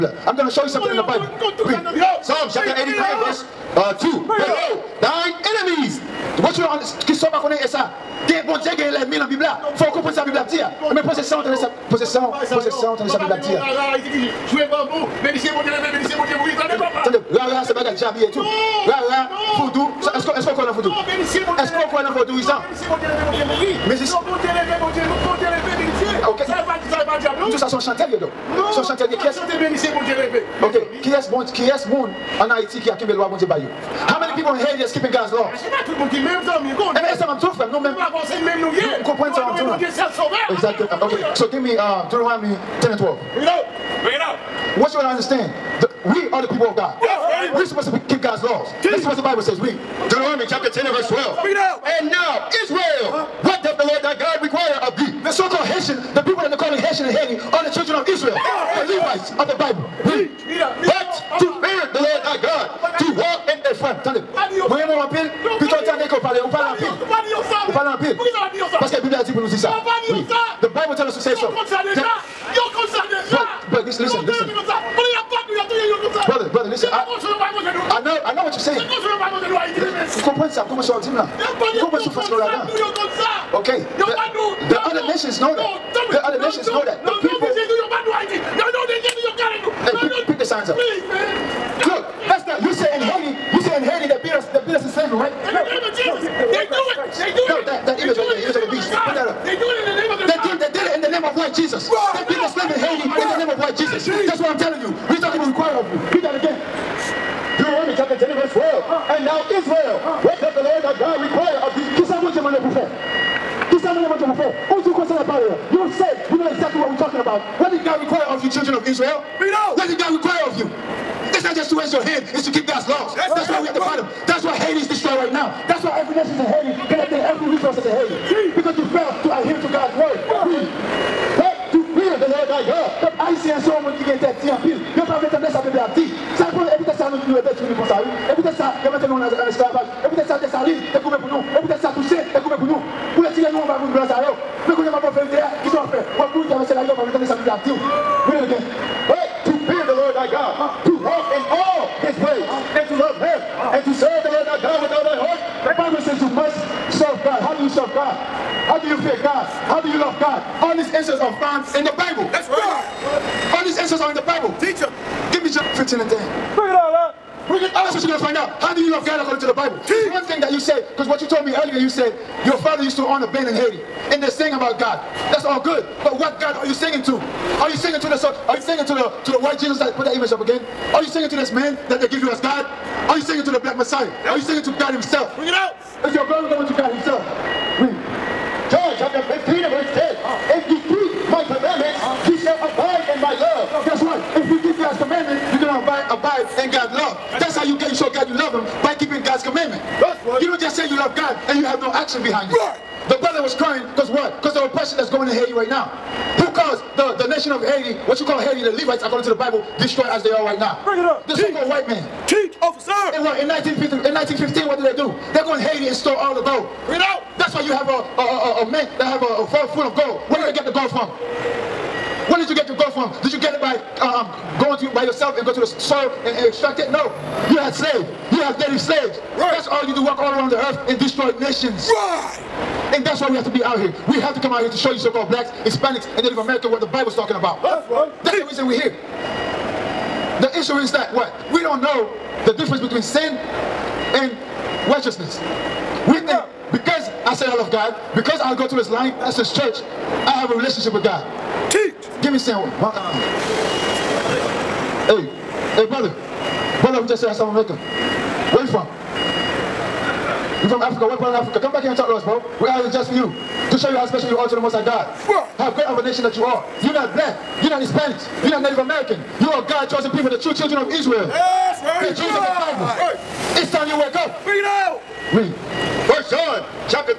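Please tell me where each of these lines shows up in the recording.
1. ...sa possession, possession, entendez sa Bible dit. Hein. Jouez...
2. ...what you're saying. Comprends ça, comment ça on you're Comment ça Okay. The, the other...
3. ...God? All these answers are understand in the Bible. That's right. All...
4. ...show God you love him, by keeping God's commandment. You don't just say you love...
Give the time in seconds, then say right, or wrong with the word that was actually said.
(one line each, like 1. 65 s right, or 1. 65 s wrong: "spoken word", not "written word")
1. 11 s right
2. 78 s right
3. 160 s wrong: "found", not "understand"
4. 197 s right.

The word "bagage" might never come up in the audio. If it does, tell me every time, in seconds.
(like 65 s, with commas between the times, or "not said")
17 s.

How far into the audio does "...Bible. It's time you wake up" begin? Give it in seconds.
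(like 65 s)
272 s.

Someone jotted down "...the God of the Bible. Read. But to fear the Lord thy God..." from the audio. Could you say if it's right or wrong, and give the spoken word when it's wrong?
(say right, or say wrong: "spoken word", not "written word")
wrong: "Levites", not "God".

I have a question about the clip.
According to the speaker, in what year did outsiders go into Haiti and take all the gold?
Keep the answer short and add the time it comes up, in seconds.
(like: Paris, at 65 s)
1915, at 214 s.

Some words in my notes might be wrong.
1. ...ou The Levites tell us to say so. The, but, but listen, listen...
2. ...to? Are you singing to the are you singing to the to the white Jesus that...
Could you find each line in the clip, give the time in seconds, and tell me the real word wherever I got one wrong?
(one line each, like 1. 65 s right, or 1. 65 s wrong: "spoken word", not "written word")
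1. 69 s wrong: "Bible", not "Levites"
2. 177 s right.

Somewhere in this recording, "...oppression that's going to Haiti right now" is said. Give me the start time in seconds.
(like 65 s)
204 s.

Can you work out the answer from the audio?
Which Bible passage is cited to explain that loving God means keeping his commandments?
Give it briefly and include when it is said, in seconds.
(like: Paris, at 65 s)
John 15, at 188 s.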